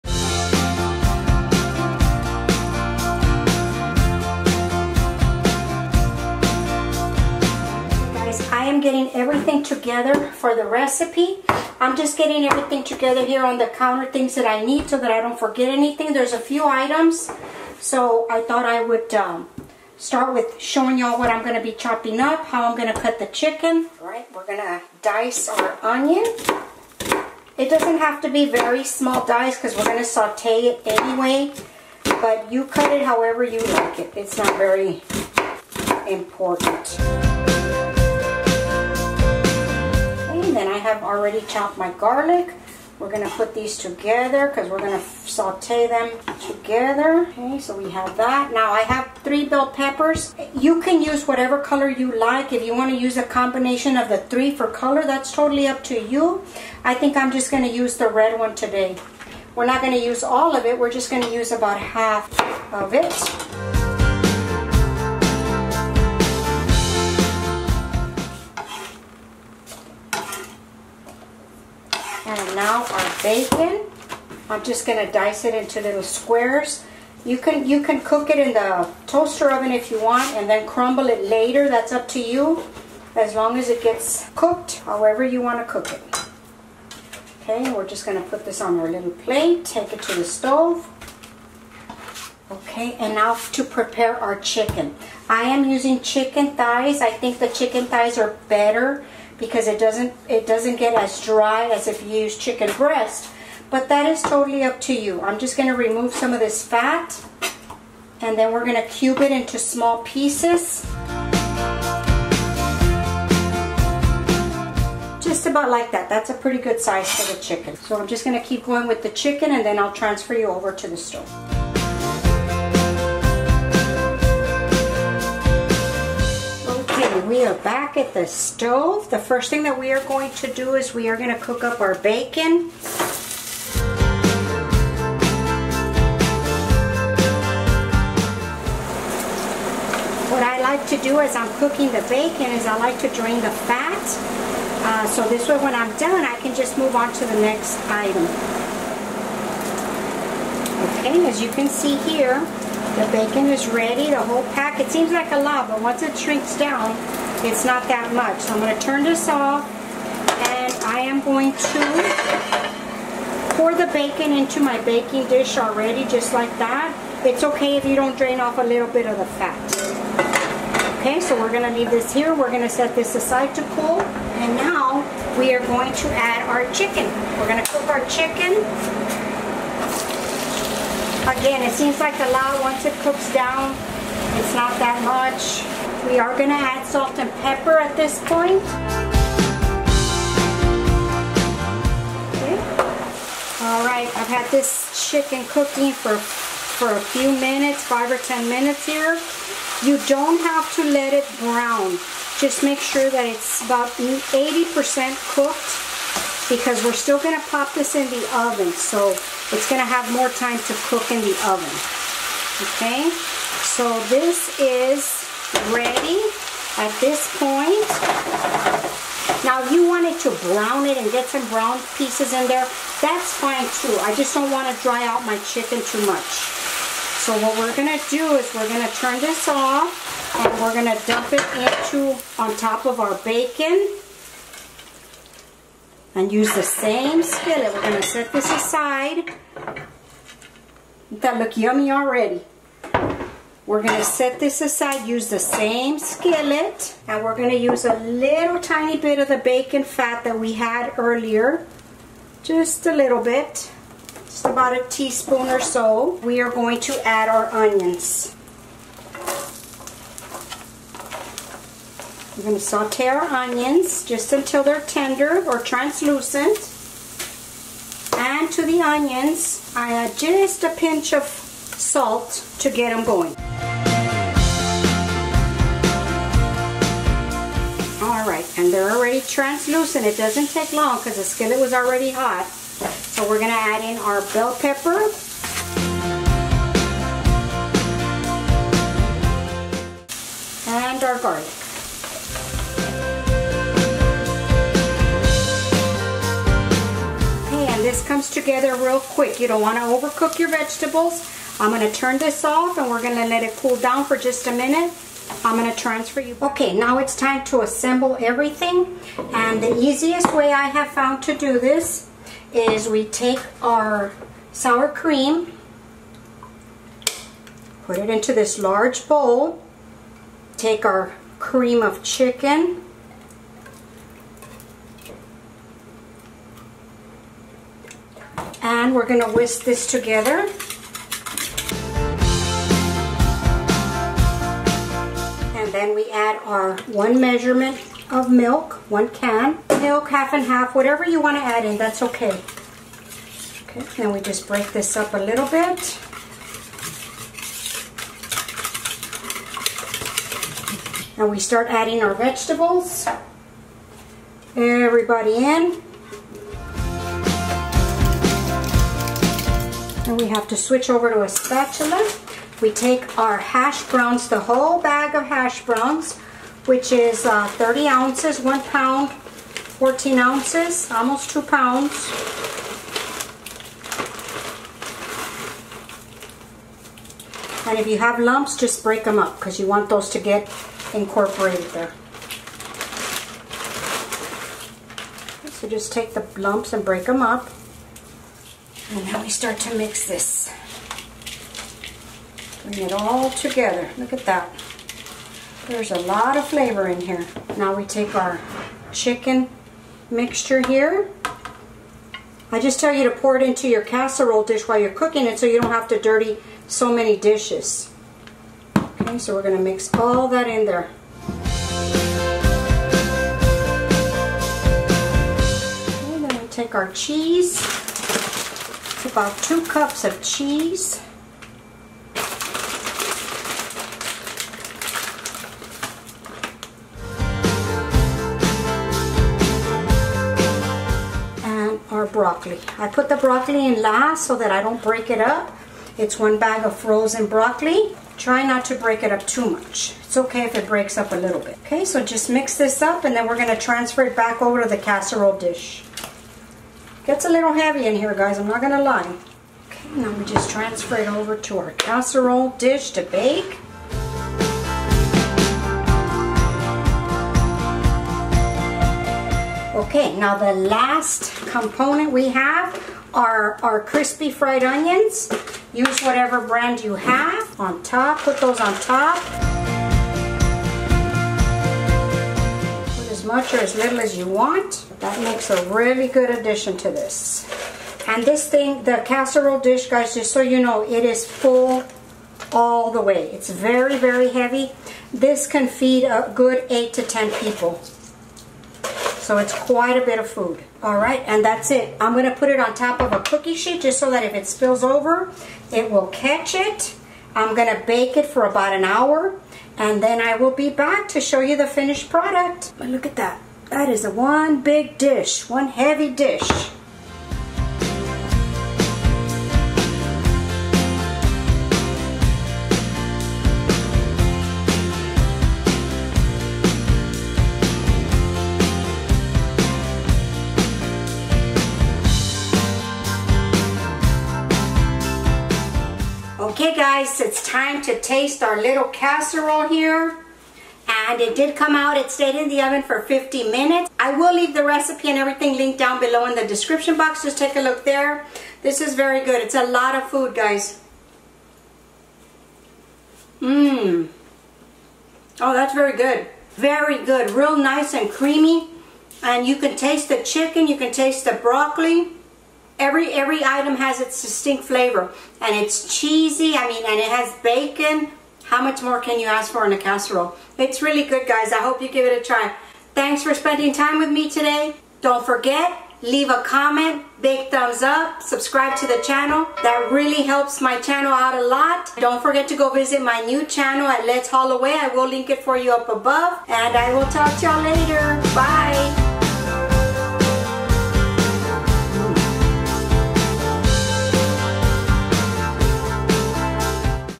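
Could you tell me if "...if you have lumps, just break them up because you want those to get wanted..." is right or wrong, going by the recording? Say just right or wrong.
wrong.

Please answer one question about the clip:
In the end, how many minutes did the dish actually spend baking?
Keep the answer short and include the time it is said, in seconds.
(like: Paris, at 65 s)
50 minutes, at 533 s.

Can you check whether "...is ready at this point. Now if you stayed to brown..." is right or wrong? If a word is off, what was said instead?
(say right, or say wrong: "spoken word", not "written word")
wrong: "wanted", not "stayed".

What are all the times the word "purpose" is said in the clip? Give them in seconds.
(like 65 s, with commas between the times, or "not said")
not said.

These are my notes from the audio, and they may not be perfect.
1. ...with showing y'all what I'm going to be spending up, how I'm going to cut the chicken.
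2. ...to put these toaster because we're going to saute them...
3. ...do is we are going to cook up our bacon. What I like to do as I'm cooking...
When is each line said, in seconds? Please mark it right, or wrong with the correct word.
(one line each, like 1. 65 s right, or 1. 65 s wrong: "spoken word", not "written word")
1. 20 s wrong: "chopping", not "spending"
2. 43 s wrong: "together", not "toaster"
3. 130 s right.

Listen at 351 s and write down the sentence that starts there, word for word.
And we start adding our vegetables.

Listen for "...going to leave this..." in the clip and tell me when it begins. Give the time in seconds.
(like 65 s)
171 s.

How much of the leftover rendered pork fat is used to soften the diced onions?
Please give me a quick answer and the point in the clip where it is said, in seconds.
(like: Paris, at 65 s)
About a teaspoon, at 254 s.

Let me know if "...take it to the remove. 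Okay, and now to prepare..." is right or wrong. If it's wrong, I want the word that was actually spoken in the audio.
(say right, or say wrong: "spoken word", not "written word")
wrong: "stove", not "remove".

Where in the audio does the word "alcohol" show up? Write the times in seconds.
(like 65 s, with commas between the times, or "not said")
not said.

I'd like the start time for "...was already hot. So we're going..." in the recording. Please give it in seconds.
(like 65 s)
281 s.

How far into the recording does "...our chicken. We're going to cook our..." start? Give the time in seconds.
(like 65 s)
176 s.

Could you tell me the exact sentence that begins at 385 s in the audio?
So just take the lumps and break them up.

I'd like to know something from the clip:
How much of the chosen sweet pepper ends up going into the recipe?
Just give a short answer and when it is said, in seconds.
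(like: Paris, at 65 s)
About half, at 61 s.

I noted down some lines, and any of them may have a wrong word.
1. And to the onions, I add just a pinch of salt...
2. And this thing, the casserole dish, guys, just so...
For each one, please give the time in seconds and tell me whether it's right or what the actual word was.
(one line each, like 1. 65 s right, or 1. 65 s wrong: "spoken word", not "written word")
1. 268 s right
2. 478 s right.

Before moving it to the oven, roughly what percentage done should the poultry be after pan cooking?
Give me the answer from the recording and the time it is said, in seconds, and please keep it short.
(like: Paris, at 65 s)
80%, at 203 s.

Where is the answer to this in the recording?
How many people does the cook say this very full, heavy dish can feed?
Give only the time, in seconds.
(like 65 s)
486 s.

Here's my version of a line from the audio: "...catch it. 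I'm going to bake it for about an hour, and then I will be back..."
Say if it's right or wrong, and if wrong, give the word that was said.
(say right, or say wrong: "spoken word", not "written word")
right.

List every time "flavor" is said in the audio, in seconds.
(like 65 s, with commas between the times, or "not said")
396 s, 554 s.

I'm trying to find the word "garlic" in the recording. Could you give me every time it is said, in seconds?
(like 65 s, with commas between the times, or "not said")
41 s, 291 s.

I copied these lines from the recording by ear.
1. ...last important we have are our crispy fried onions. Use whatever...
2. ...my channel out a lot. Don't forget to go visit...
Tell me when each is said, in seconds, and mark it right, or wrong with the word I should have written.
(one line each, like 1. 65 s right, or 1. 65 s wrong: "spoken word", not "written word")
1. 460 s wrong: "component", not "important"
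2. 570 s right.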